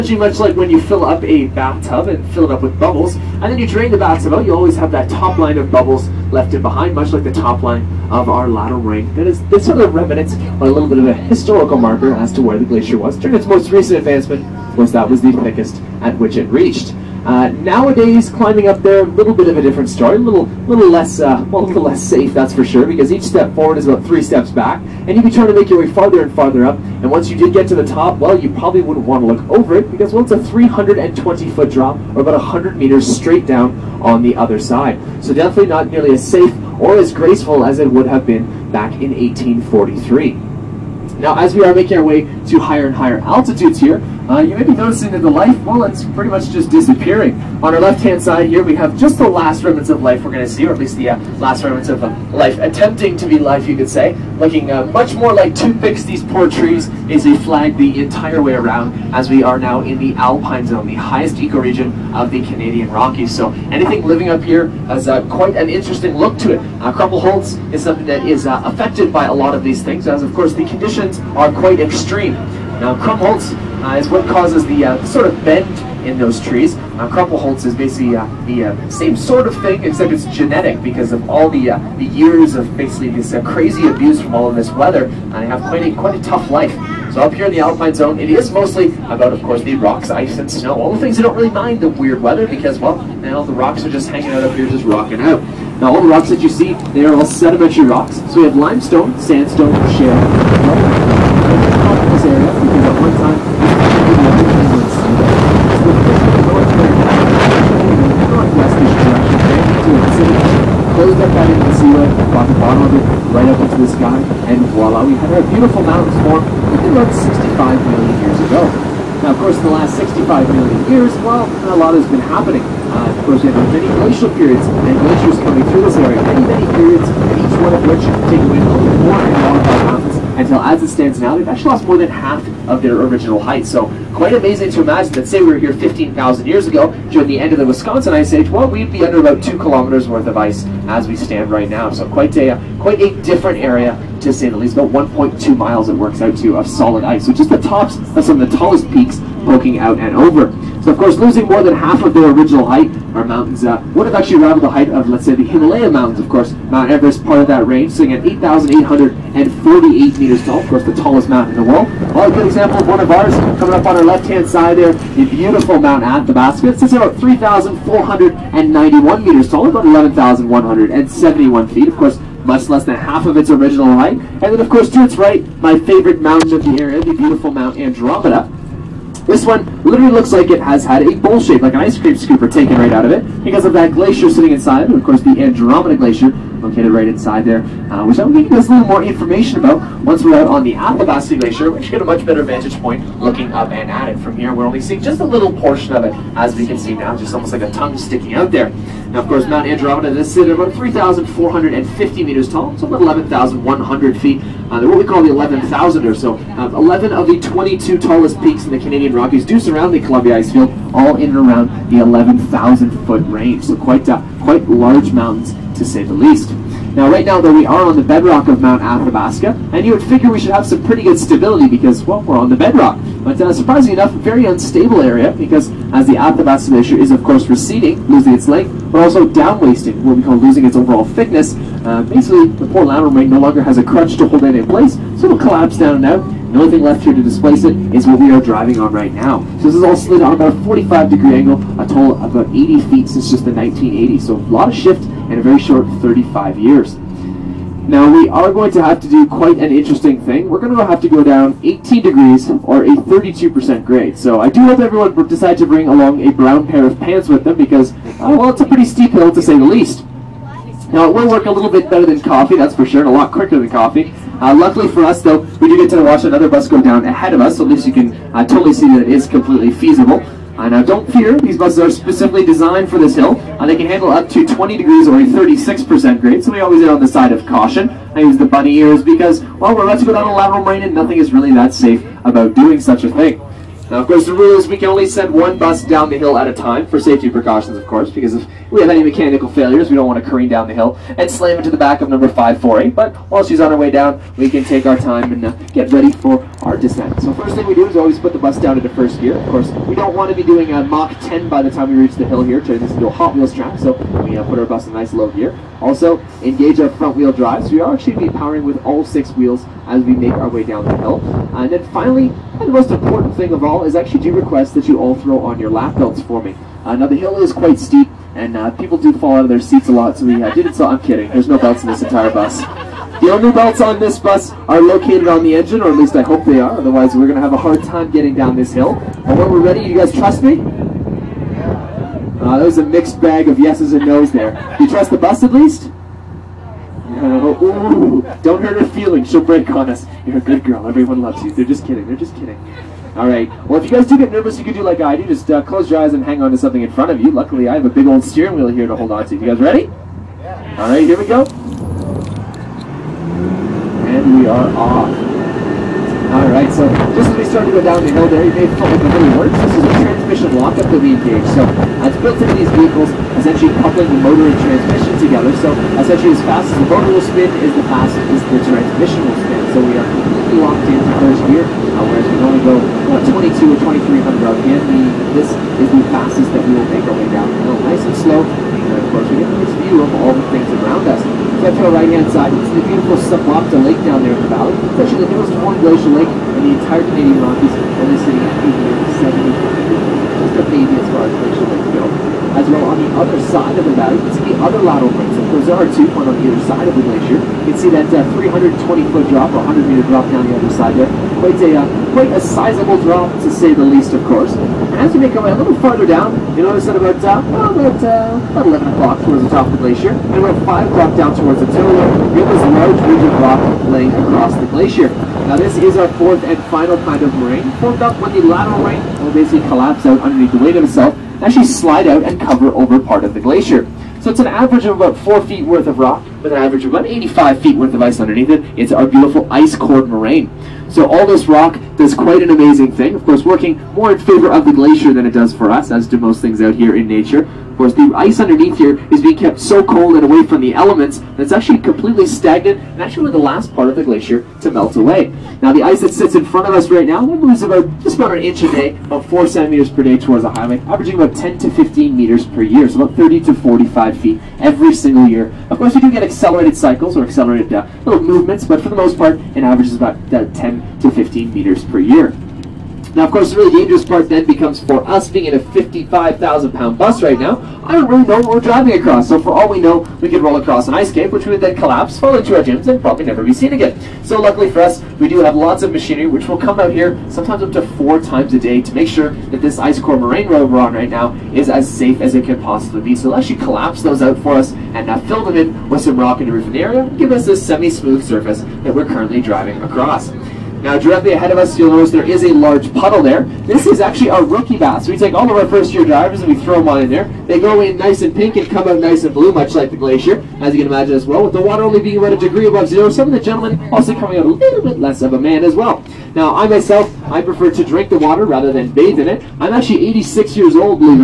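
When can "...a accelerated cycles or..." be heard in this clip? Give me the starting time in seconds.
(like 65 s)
456 s.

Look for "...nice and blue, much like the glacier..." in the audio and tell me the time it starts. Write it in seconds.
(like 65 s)
498 s.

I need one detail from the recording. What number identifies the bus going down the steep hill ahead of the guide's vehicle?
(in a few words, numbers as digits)
548.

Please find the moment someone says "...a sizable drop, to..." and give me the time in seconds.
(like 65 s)
402 s.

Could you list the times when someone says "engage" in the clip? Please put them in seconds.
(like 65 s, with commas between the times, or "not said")
306 s, 361 s.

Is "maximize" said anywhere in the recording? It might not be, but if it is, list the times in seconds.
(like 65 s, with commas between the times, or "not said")
not said.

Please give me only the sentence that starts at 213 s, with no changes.
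So quite, uh, quite large mountains, to say the least.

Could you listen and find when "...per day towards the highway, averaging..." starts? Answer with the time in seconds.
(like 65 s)
449 s.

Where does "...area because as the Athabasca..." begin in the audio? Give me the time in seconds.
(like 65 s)
225 s.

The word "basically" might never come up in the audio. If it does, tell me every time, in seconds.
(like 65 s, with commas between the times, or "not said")
77 s, 82 s, 232 s, 419 s.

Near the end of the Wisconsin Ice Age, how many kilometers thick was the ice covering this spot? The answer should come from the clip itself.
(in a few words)
2 kilometers.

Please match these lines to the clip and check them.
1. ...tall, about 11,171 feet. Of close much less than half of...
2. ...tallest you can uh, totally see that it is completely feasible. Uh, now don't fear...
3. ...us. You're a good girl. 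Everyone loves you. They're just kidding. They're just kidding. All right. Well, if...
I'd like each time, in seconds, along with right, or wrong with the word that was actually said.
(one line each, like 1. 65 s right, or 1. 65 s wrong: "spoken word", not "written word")
1. 169 s wrong: "course", not "close"
2. 267 s wrong: "least", not "tallest"
3. 339 s right.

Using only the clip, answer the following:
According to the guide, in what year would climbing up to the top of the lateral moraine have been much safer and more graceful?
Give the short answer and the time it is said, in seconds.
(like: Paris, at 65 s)
1843, at 39 s.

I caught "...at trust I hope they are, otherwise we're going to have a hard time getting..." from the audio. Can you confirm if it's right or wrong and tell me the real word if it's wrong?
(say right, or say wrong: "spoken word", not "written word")
wrong: "least", not "trust".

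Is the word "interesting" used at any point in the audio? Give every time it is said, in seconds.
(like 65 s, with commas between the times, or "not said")
65 s, 249 s.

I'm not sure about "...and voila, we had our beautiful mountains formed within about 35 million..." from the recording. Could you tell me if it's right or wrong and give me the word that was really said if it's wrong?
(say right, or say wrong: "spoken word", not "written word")
wrong: "65", not "35".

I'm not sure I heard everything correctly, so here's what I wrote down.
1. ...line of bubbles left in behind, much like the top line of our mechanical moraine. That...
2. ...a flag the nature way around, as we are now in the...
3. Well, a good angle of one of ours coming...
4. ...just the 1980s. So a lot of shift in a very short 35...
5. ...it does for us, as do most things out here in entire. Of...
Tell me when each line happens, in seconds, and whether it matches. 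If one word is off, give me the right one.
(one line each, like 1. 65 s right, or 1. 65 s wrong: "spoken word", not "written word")
1. 5 s wrong: "lateral", not "mechanical"
2. 57 s wrong: "entire", not "nature"
3. 162 s wrong: "example", not "angle"
4. 243 s right
5. 435 s wrong: "nature", not "entire".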